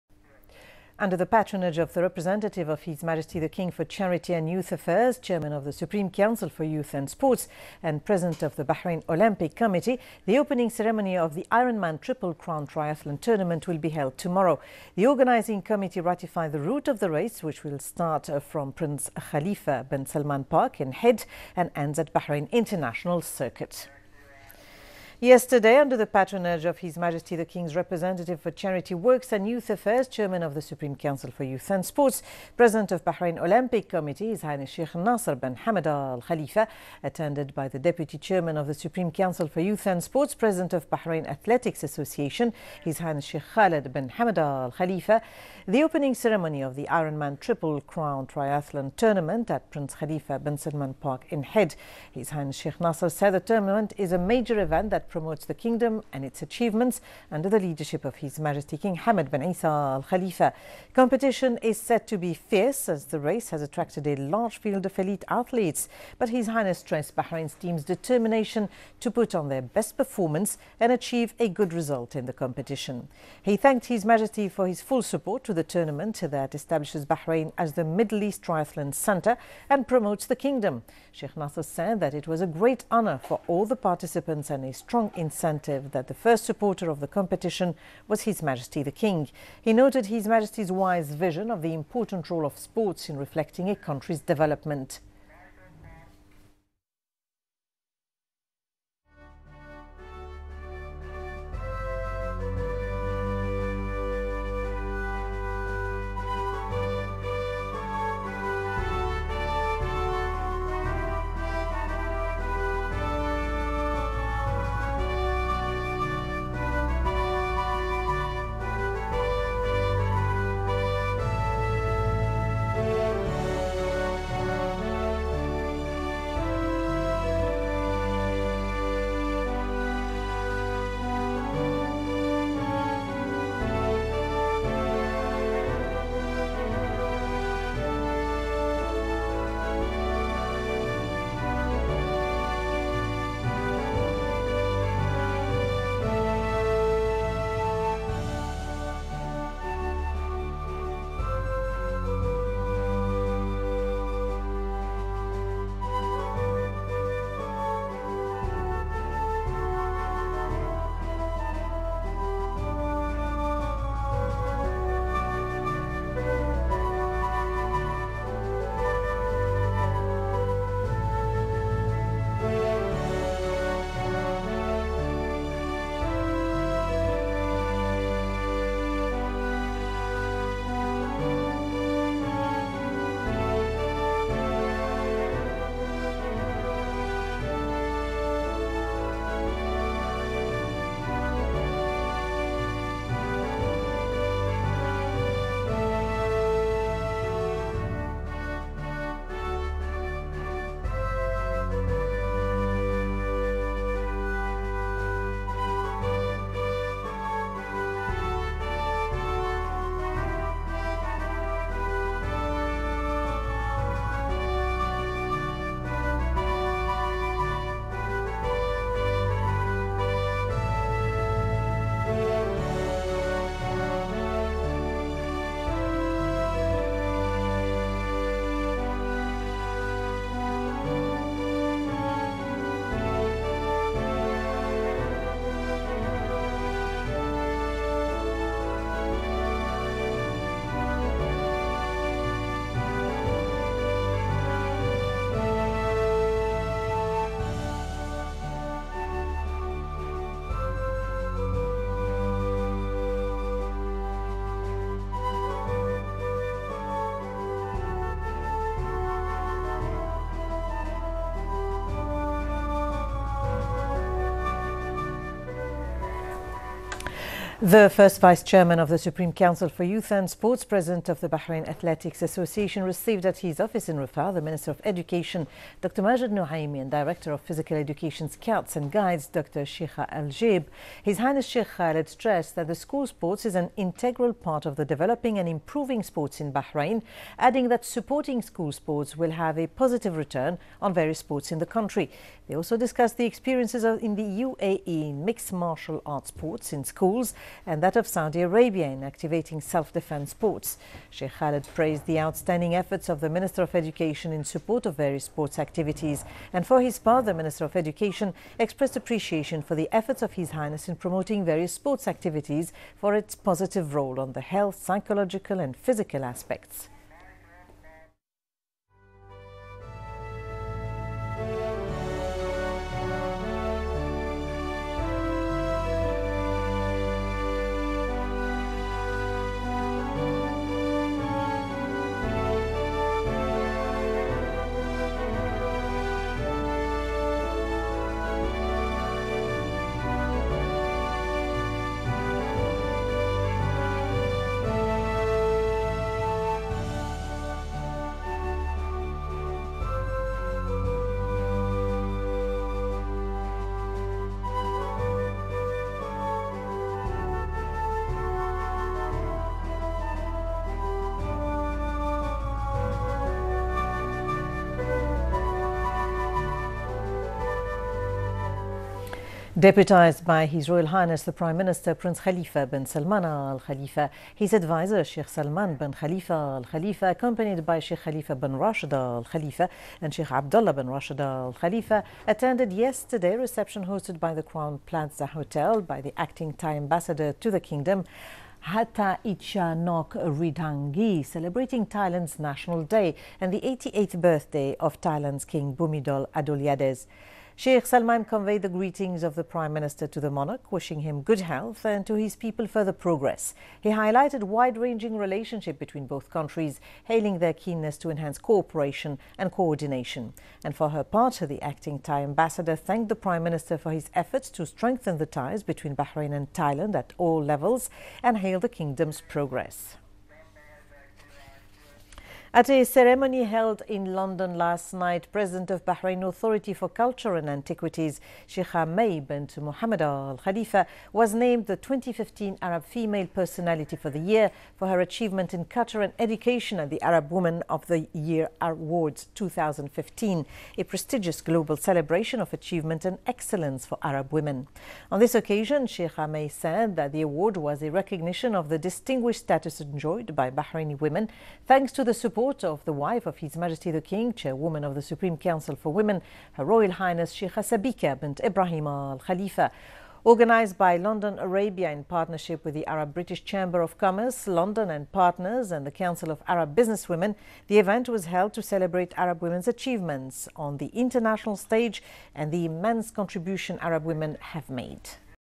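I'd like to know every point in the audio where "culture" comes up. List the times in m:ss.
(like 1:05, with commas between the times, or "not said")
7:06, 7:15.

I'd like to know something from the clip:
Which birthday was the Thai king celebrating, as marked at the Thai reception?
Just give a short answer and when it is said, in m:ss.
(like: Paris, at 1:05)
88th, at 6:33.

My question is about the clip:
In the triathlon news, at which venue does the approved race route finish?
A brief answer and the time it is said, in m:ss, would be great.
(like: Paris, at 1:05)
Bahrain International Circuit, at 0:22.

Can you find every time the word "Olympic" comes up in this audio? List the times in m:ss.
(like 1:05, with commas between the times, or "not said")
0:09, 0:33.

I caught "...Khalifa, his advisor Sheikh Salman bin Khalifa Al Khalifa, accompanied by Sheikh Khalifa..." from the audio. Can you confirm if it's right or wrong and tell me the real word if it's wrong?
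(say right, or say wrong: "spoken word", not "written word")
right.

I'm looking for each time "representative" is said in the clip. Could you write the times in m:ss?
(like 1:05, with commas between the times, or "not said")
0:02, 0:27.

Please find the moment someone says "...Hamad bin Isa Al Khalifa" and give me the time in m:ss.
0:58.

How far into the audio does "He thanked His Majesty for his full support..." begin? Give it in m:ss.
1:13.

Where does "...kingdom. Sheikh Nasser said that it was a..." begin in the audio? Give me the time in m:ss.
1:20.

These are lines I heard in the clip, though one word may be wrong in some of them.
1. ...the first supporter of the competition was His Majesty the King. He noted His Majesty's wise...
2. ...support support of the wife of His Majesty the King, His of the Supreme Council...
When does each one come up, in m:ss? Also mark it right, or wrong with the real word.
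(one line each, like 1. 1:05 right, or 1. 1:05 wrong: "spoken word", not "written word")
1. 1:26 right
2. 7:32 wrong: "Chairwoman", not "His".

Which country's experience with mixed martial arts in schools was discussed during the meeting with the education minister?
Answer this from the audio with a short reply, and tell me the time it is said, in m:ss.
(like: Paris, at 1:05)
UAE, at 4:54.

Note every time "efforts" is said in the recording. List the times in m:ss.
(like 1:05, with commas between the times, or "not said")
5:02, 5:09, 6:54.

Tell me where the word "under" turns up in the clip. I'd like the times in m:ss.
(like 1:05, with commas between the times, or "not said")
0:01, 0:25, 0:57.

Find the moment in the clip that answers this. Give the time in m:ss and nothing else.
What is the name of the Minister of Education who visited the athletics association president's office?
4:36.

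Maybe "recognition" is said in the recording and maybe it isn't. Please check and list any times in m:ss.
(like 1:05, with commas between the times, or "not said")
7:27.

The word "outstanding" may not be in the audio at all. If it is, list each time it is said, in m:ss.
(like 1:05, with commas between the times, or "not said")
5:02.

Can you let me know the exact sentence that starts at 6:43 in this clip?
He highlighted wide-ranging relationship between both countries, hailing their keenness to enhance cooperation and coordination.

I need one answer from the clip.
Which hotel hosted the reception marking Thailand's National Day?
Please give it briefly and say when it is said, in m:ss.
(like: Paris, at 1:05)
Crowne Plaza Hotel, at 6:24.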